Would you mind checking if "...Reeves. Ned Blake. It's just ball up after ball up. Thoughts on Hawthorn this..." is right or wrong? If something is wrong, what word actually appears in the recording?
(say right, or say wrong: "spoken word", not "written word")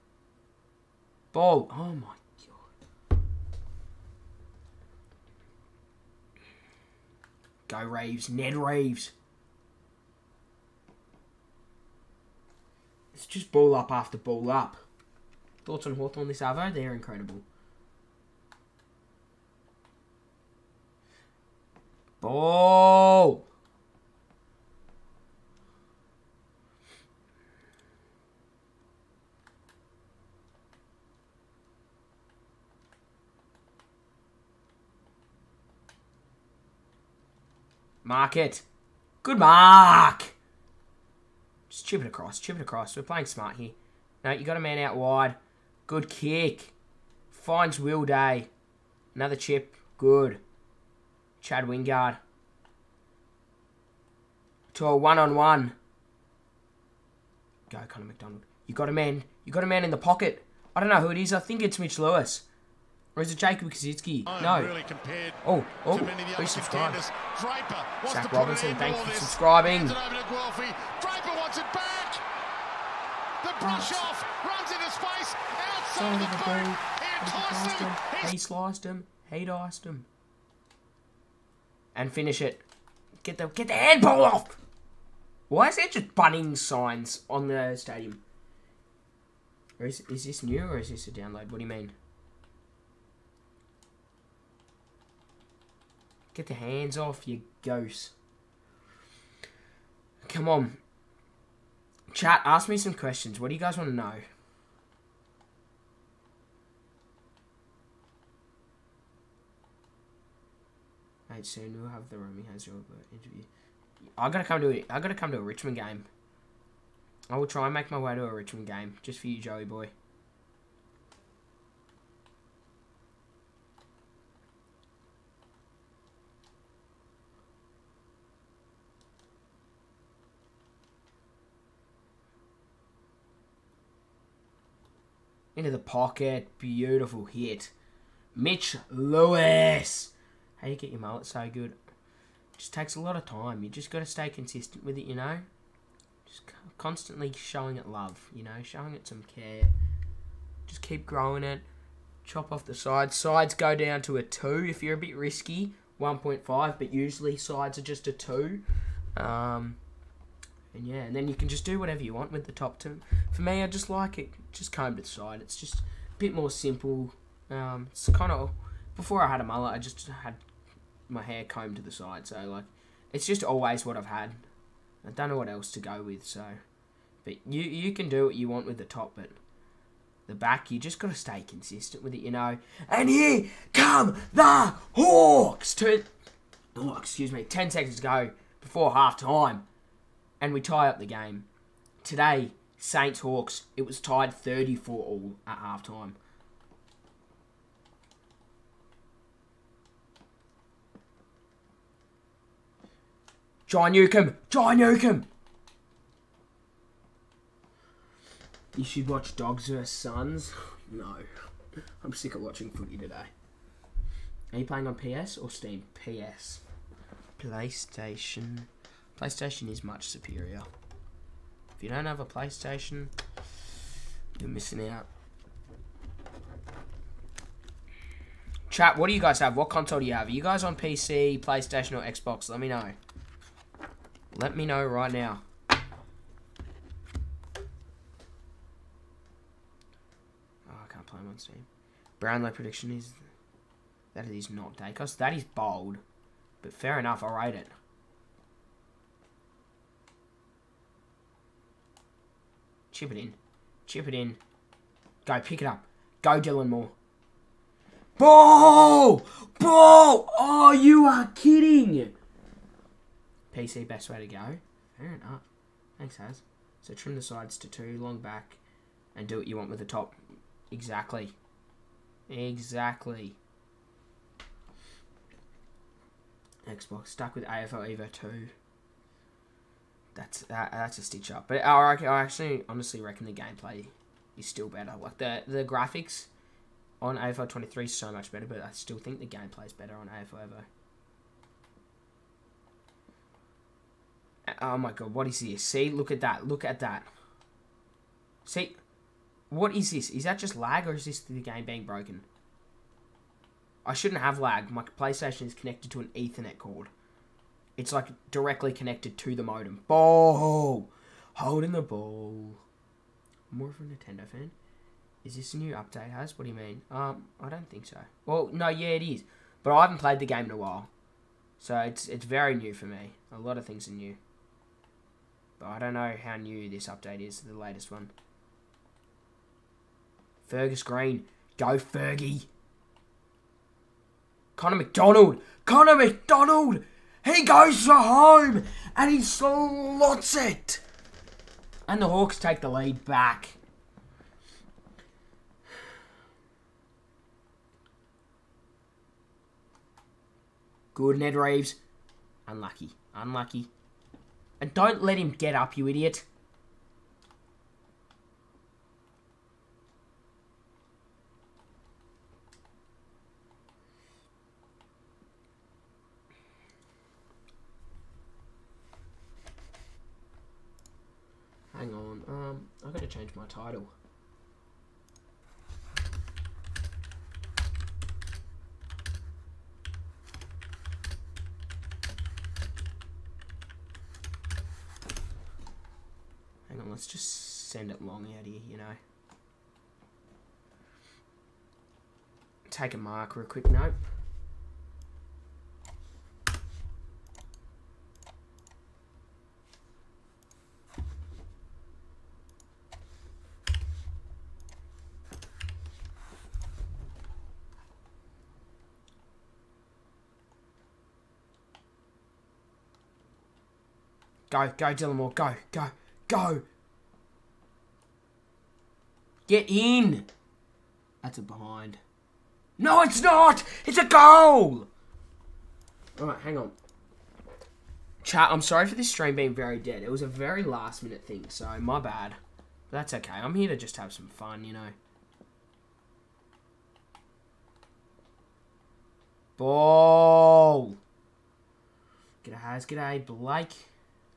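wrong: "Reeves", not "Blake".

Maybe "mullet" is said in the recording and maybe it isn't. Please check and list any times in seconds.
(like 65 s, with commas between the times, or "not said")
140 s, 169 s.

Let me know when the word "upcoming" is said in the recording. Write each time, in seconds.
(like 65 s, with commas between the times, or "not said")
not said.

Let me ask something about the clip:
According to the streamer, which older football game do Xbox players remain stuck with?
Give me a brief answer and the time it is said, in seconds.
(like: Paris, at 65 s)
AFL Evo 2, at 277 s.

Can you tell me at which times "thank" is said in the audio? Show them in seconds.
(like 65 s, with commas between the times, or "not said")
68 s, 265 s.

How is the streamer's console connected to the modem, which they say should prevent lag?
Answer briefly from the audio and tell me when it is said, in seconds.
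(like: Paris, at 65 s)
Ethernet cord, at 306 s.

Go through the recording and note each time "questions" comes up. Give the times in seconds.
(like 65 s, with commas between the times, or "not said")
102 s.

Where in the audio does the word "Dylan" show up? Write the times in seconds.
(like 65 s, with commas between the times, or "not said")
256 s, 414 s.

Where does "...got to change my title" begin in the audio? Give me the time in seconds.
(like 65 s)
372 s.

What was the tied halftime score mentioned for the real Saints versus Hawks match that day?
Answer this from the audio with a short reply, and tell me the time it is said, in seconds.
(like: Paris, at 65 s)
34 all, at 194 s.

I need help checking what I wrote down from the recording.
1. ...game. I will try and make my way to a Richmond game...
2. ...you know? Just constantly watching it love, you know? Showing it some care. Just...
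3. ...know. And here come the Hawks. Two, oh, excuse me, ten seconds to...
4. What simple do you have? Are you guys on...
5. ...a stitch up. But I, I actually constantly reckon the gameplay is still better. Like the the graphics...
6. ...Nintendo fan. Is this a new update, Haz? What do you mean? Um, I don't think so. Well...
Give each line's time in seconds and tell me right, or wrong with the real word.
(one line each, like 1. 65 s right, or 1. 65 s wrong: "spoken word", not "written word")
1. 115 s right
2. 145 s wrong: "showing", not "watching"
3. 182 s right
4. 229 s wrong: "console", not "simple"
5. 280 s wrong: "honestly", not "constantly"
6. 313 s right.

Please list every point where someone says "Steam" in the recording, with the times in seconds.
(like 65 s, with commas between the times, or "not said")
215 s, 241 s.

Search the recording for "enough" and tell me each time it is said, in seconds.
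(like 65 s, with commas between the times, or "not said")
246 s, 265 s.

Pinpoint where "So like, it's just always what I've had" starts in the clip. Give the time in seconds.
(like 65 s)
172 s.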